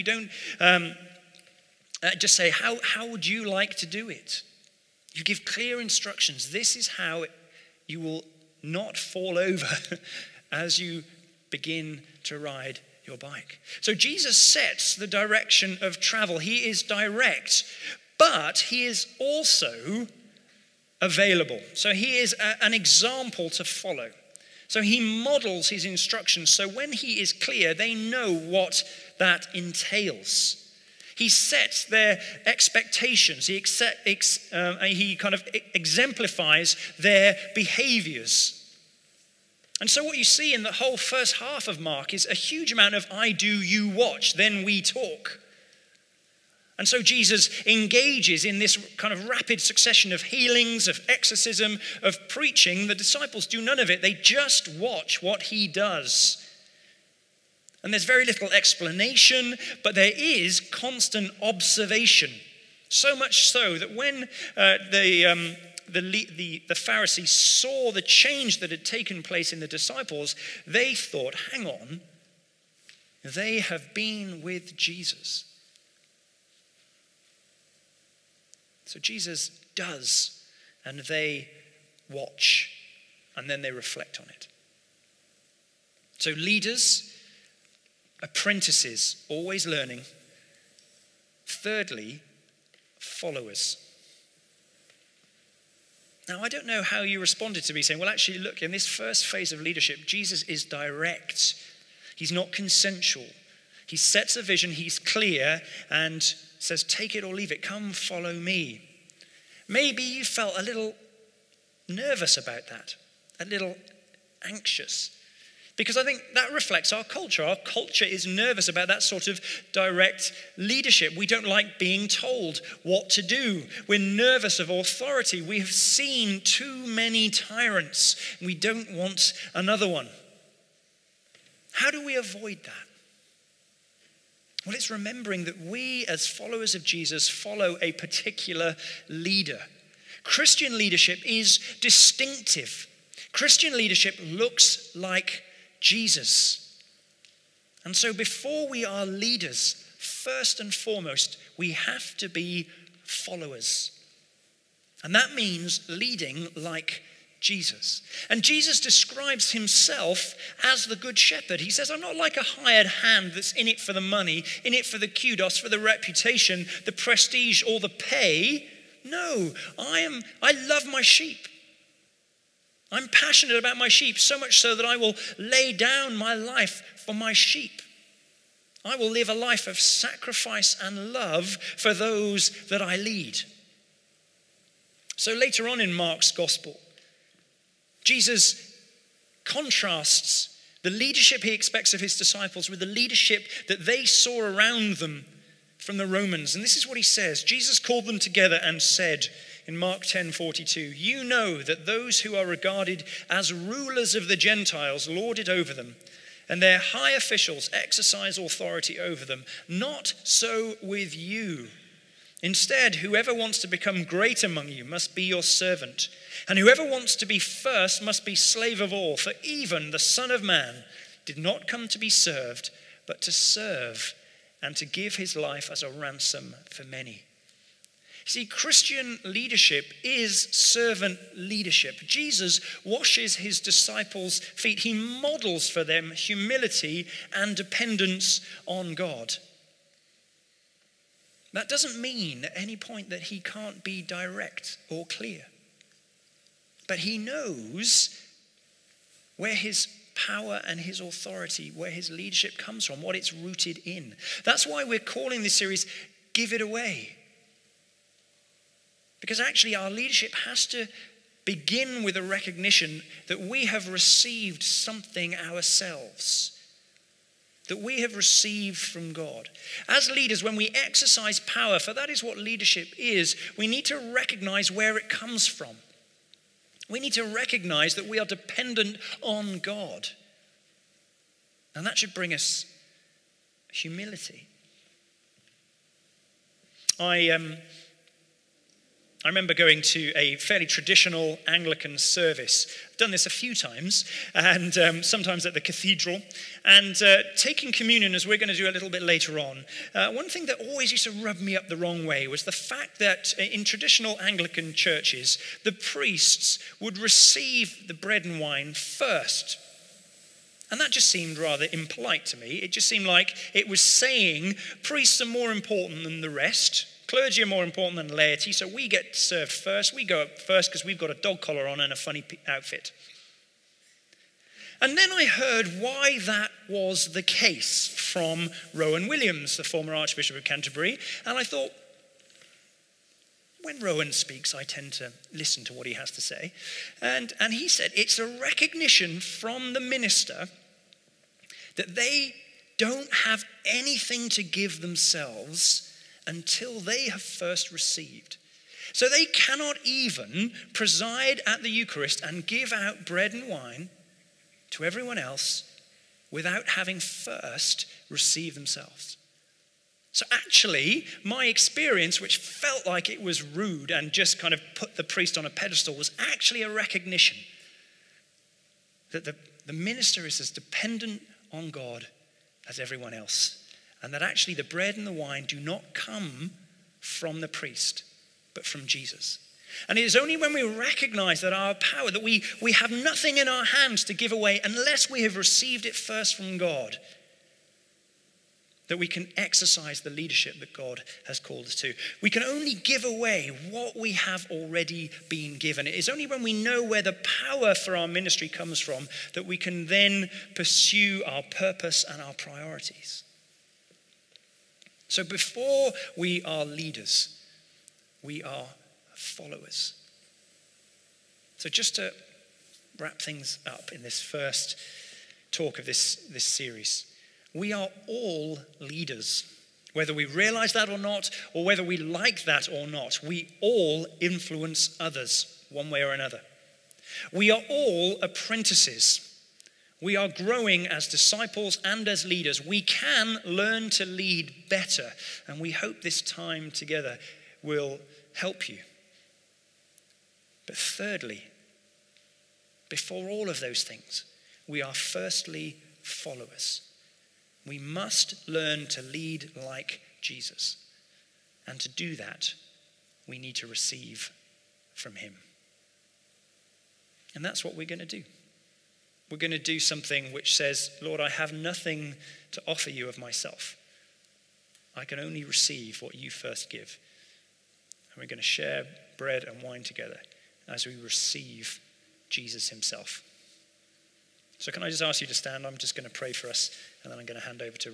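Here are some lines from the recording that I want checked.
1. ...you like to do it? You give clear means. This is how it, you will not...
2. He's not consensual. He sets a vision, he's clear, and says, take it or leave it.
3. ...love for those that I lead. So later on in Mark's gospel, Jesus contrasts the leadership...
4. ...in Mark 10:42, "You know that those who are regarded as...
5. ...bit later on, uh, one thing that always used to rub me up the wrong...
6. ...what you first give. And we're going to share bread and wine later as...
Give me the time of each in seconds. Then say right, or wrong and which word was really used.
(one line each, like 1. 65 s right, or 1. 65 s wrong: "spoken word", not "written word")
1. 3 s wrong: "instructions", not "means"
2. 102 s right
3. 181 s right
4. 199 s right
5. 298 s right
6. 466 s wrong: "together", not "later".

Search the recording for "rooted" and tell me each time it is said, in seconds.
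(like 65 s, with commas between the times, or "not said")
253 s.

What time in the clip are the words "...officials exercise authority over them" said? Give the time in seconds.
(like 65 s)
207 s.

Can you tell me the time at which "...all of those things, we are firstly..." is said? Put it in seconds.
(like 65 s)
443 s.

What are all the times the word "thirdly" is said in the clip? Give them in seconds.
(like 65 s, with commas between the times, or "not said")
91 s, 440 s.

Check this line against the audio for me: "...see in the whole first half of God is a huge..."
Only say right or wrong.
wrong.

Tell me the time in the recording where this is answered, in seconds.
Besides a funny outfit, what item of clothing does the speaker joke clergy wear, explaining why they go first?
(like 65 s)
321 s.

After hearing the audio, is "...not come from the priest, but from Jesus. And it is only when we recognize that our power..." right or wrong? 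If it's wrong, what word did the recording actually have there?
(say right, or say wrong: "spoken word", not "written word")
right.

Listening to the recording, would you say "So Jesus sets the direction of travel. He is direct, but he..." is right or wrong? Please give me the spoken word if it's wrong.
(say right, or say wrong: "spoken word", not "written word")
right.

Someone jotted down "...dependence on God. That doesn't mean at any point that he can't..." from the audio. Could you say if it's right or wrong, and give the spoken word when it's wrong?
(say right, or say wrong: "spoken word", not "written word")
right.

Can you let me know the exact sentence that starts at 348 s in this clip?
So they cannot even preside at the Eucharist and give out bread and wine to everyone else without having first received themselves.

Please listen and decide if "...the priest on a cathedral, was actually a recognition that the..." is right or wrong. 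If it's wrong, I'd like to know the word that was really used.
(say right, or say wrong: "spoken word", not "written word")
wrong: "pedestal", not "cathedral".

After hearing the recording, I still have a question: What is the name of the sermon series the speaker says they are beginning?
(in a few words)
Give It Away.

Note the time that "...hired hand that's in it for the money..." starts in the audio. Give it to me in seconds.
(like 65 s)
162 s.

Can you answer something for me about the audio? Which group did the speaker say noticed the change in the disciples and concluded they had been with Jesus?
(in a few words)
The Pharisees.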